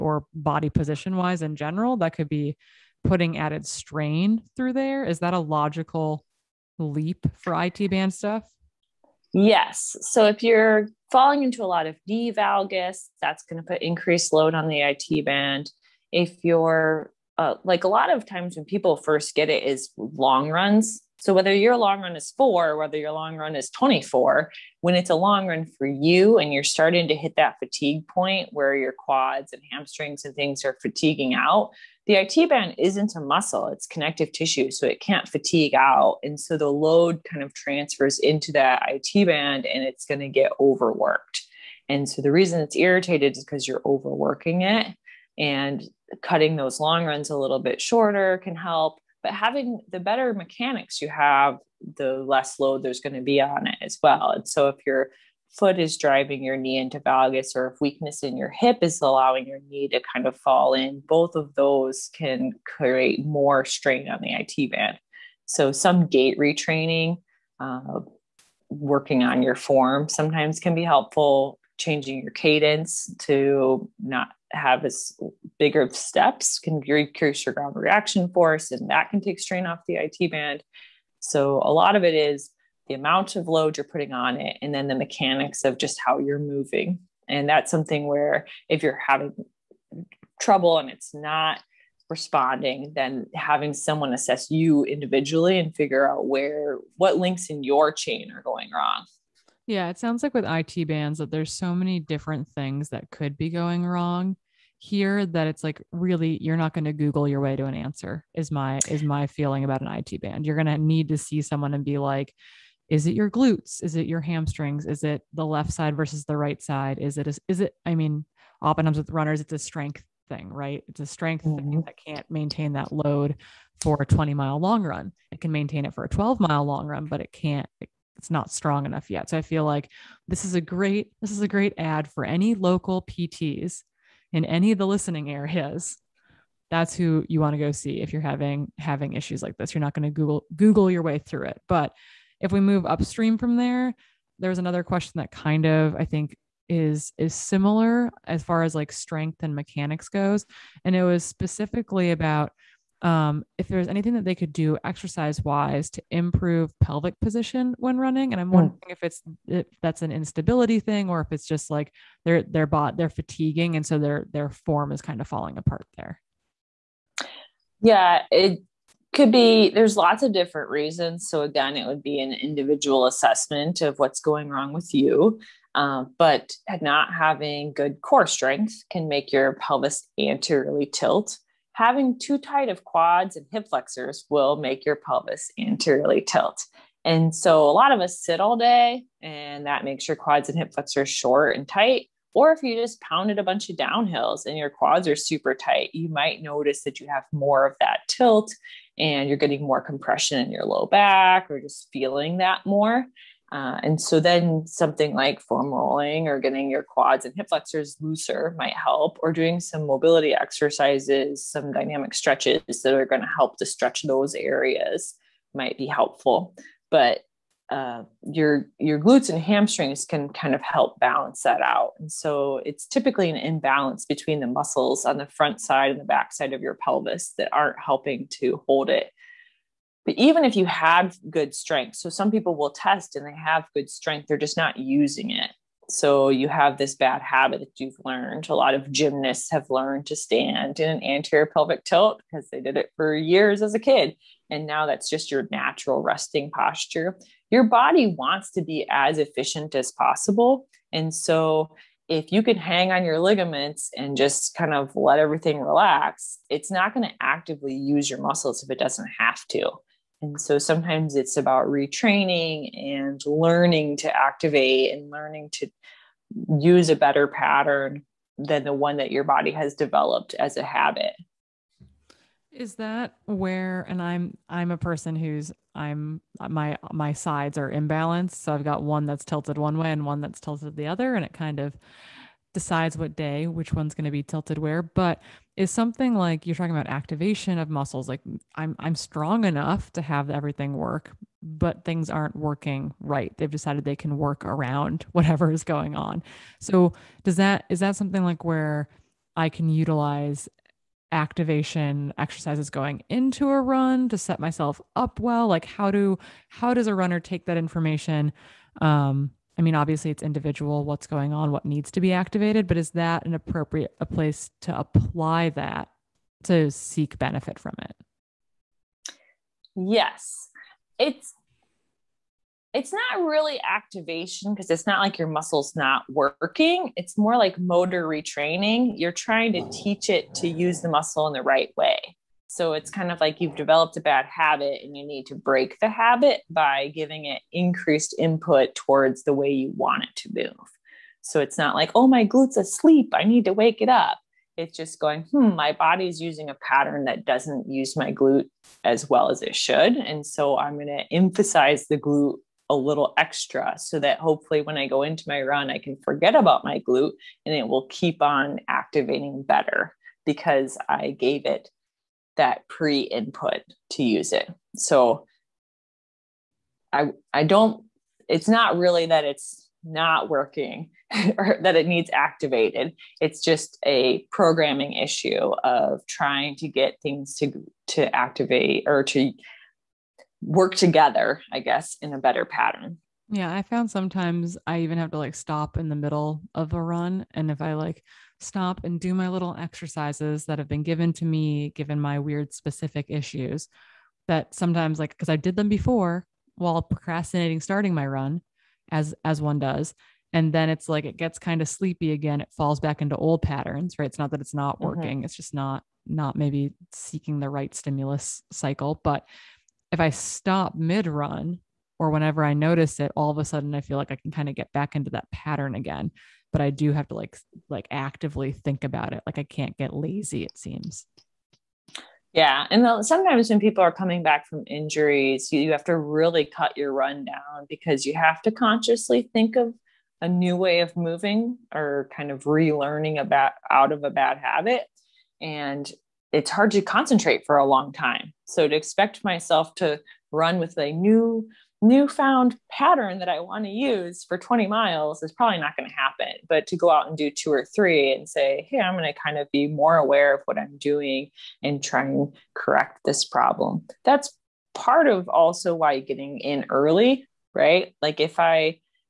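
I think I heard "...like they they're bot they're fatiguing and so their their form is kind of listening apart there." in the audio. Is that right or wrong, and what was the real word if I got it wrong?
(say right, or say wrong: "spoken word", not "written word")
wrong: "falling", not "listening".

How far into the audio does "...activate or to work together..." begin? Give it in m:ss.
6:18.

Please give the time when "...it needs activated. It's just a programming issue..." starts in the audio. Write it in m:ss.
6:11.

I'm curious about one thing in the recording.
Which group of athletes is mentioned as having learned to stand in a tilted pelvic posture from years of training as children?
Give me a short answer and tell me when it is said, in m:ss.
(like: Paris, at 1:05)
gymnasts, at 3:58.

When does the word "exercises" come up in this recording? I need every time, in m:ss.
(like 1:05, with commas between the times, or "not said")
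2:34, 3:30, 5:02, 6:29.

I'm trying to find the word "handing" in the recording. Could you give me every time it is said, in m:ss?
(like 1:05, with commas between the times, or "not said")
not said.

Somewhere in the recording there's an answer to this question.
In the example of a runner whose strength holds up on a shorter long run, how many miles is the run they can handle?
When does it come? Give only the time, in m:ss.
2:06.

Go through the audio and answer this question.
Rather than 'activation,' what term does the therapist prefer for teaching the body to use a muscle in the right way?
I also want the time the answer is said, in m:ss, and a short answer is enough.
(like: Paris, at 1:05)
motor retraining, at 5:27.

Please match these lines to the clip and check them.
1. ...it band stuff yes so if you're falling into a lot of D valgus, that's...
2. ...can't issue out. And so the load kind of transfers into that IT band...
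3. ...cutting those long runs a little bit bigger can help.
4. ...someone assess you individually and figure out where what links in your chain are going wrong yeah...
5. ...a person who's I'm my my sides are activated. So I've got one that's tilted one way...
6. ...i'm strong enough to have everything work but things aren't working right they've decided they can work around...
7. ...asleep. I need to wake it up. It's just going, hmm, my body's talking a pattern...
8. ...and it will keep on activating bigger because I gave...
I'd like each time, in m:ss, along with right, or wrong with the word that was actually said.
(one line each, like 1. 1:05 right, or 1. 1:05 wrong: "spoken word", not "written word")
1. 0:07 right
2. 0:35 wrong: "fatigue", not "issue"
3. 0:46 wrong: "shorter", not "bigger"
4. 1:33 right
5. 4:34 wrong: "imbalanced", not "activated"
6. 4:48 right
7. 5:42 wrong: "using", not "talking"
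8. 5:57 wrong: "better", not "bigger".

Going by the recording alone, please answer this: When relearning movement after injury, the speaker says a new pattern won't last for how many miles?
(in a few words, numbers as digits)
20.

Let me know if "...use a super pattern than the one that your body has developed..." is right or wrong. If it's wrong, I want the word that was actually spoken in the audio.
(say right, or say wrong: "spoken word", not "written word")
wrong: "better", not "super".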